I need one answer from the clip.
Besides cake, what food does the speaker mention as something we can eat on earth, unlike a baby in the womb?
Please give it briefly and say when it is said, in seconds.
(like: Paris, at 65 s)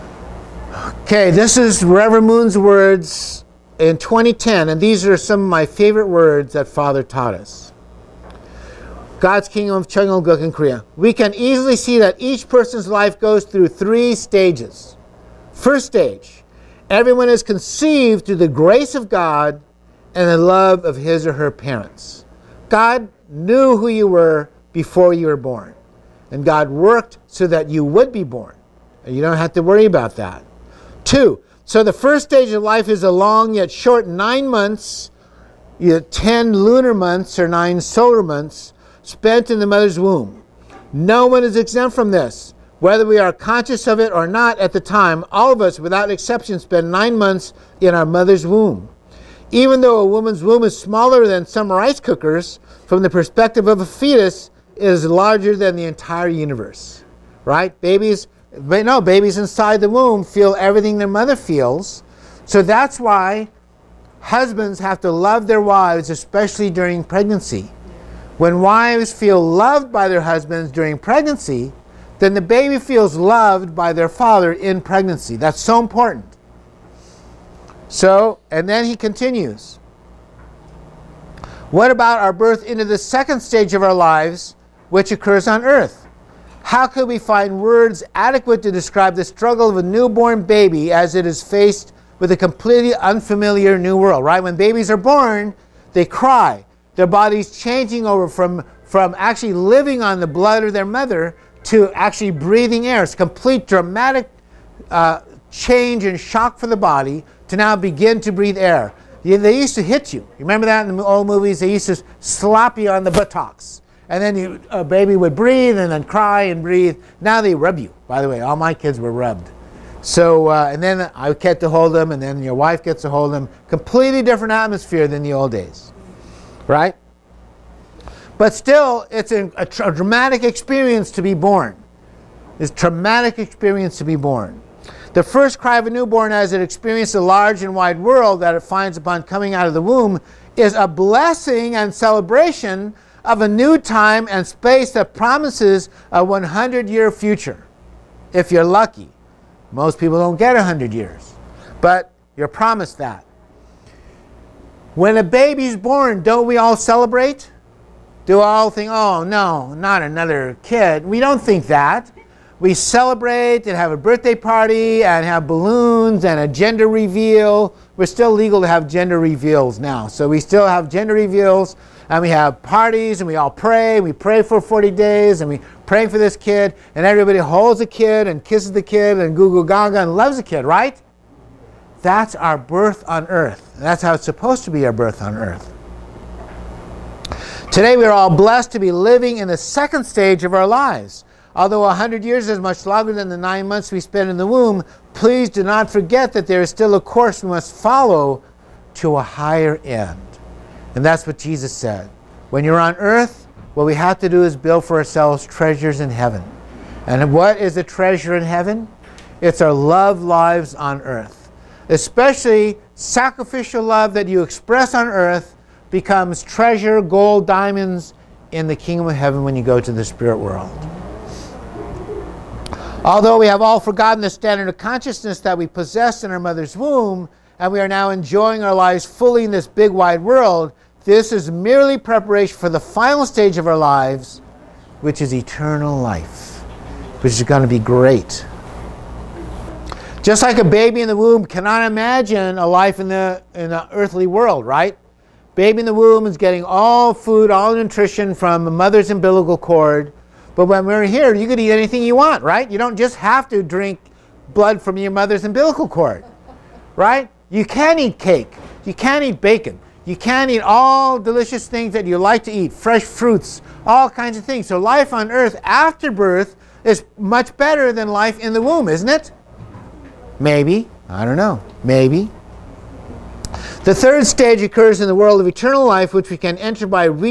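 Bacon, at 259 s.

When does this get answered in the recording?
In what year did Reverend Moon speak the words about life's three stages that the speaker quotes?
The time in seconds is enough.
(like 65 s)
3 s.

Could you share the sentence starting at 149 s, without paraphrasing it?
Most people don't get 100 years, but you're promised that.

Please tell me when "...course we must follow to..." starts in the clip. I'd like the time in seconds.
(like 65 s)
197 s.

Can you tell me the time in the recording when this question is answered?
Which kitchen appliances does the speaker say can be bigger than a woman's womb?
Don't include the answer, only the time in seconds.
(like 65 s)
51 s.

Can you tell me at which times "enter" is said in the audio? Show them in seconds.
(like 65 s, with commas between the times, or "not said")
276 s.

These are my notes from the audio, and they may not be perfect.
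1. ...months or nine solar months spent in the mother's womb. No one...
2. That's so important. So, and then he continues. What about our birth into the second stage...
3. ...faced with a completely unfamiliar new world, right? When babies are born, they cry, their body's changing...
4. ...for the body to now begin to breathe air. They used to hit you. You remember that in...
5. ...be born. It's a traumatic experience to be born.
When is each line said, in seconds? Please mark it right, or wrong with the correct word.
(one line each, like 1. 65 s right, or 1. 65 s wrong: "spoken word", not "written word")
1. 36 s right
2. 75 s right
3. 91 s right
4. 106 s right
5. 131 s right.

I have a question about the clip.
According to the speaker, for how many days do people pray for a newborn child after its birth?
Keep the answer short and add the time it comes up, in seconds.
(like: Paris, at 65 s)
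40, at 174 s.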